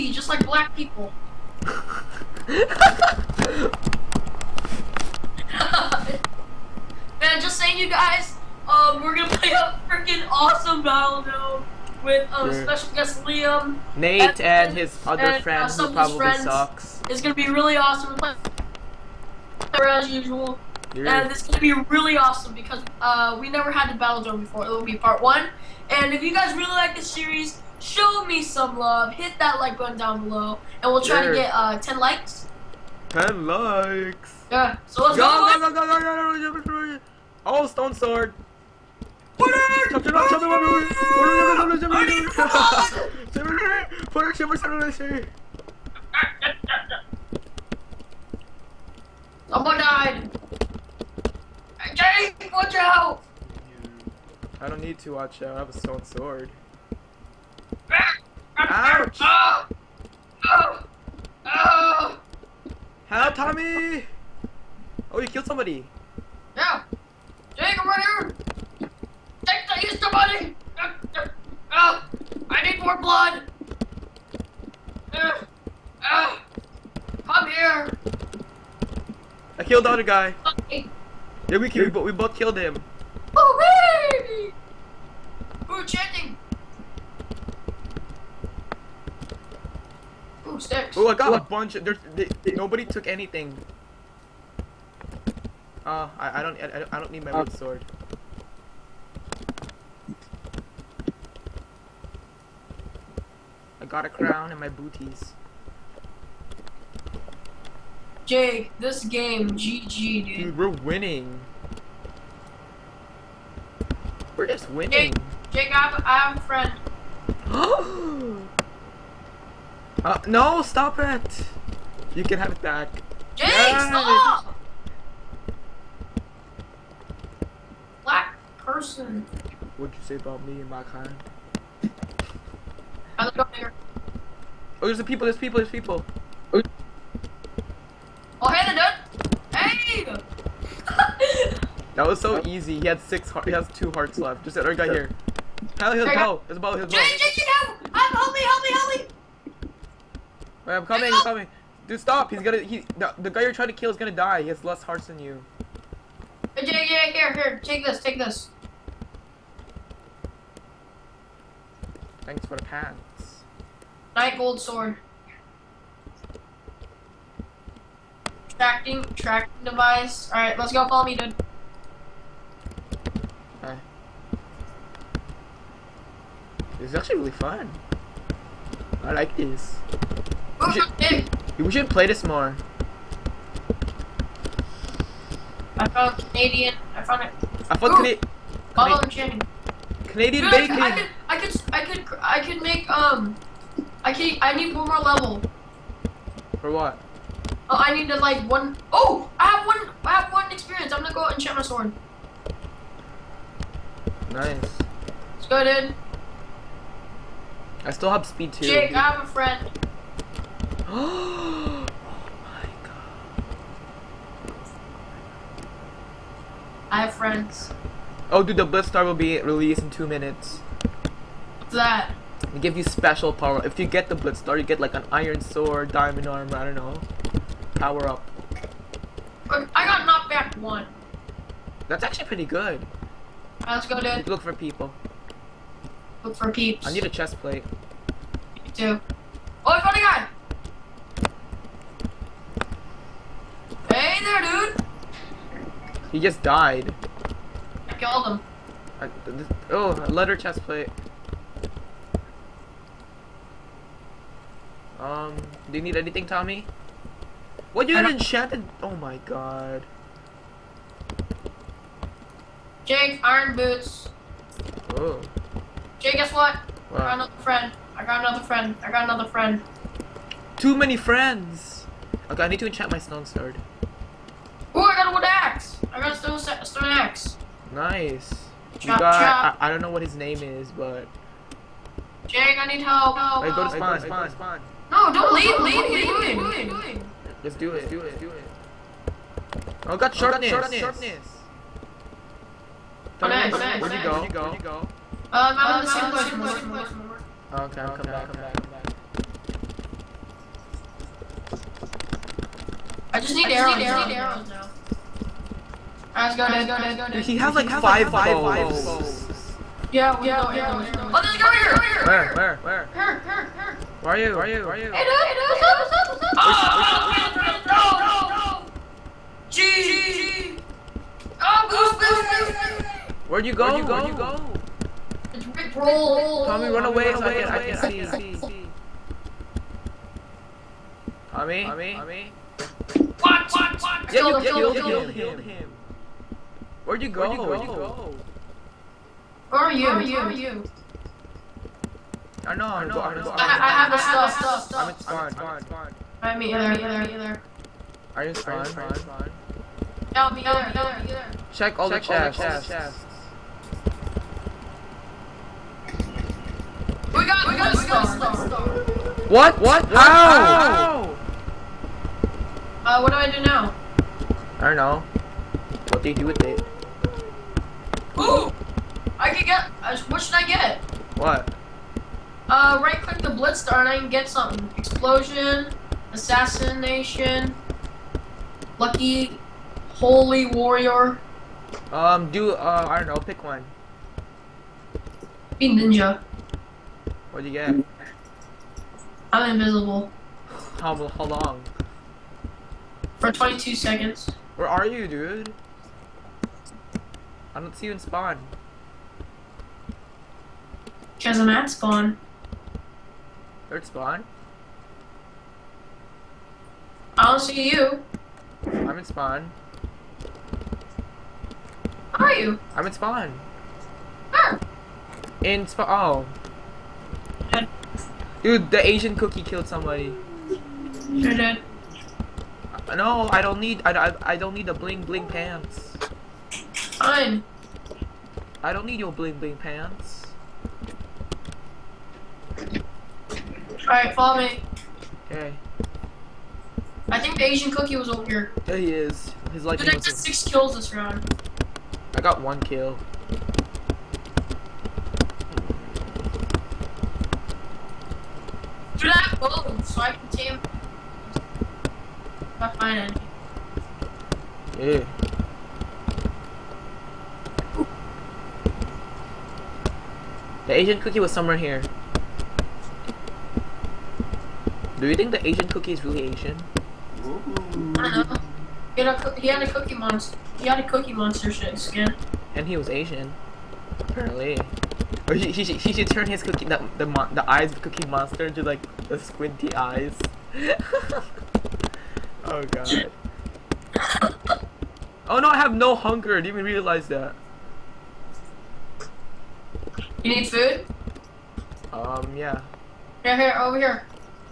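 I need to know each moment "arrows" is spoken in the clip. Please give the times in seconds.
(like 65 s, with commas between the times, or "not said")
303 s, 310 s.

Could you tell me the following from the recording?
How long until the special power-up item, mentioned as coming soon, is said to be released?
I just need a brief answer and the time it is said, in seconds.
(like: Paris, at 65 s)
2 minutes, at 219 s.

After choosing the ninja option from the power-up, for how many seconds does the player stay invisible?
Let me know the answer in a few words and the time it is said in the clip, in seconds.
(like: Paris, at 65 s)
22 seconds, at 393 s.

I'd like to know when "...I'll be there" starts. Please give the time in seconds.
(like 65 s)
350 s.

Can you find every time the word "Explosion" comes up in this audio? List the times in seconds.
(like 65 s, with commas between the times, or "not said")
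374 s.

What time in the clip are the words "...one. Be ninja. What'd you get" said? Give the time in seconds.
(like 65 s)
383 s.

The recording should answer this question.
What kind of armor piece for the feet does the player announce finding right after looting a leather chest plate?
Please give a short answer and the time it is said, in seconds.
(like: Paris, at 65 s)
Iron boots, at 263 s.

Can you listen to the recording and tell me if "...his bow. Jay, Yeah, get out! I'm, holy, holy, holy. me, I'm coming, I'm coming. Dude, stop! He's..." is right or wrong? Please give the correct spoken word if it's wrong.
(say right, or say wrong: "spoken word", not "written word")
wrong: "Jay", not "Yeah".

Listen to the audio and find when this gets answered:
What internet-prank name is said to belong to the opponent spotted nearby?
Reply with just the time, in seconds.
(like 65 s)
325 s.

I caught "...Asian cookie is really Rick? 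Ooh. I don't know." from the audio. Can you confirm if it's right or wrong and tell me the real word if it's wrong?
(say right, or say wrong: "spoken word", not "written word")
wrong: "Asian", not "Rick".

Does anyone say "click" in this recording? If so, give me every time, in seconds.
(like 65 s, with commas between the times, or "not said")
373 s.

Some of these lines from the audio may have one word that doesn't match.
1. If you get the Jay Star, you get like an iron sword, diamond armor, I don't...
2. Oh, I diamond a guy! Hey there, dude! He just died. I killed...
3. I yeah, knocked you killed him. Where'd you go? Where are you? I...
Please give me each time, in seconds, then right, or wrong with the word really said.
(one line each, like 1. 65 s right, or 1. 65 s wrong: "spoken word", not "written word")
1. 223 s wrong: "Blitz", not "Jay"
2. 239 s wrong: "found", not "diamond"
3. 334 s wrong: "killed", not "knocked".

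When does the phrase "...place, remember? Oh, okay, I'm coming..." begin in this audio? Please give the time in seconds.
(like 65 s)
296 s.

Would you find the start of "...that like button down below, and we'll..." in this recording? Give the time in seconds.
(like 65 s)
29 s.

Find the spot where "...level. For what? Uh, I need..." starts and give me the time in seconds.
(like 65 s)
194 s.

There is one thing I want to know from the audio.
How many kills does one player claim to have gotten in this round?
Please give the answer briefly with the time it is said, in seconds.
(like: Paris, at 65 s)
6, at 439 s.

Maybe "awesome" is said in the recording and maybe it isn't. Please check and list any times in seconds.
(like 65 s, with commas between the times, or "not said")
10 s, 17 s, 22 s.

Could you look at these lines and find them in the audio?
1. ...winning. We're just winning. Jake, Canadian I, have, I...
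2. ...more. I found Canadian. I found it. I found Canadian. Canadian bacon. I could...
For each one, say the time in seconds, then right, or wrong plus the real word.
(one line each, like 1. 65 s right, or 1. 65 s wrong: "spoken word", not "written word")
1. 110 s wrong: "Jake", not "Canadian"
2. 182 s right.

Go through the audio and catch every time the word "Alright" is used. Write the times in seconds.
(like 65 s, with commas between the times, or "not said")
170 s, 232 s, 306 s, 433 s.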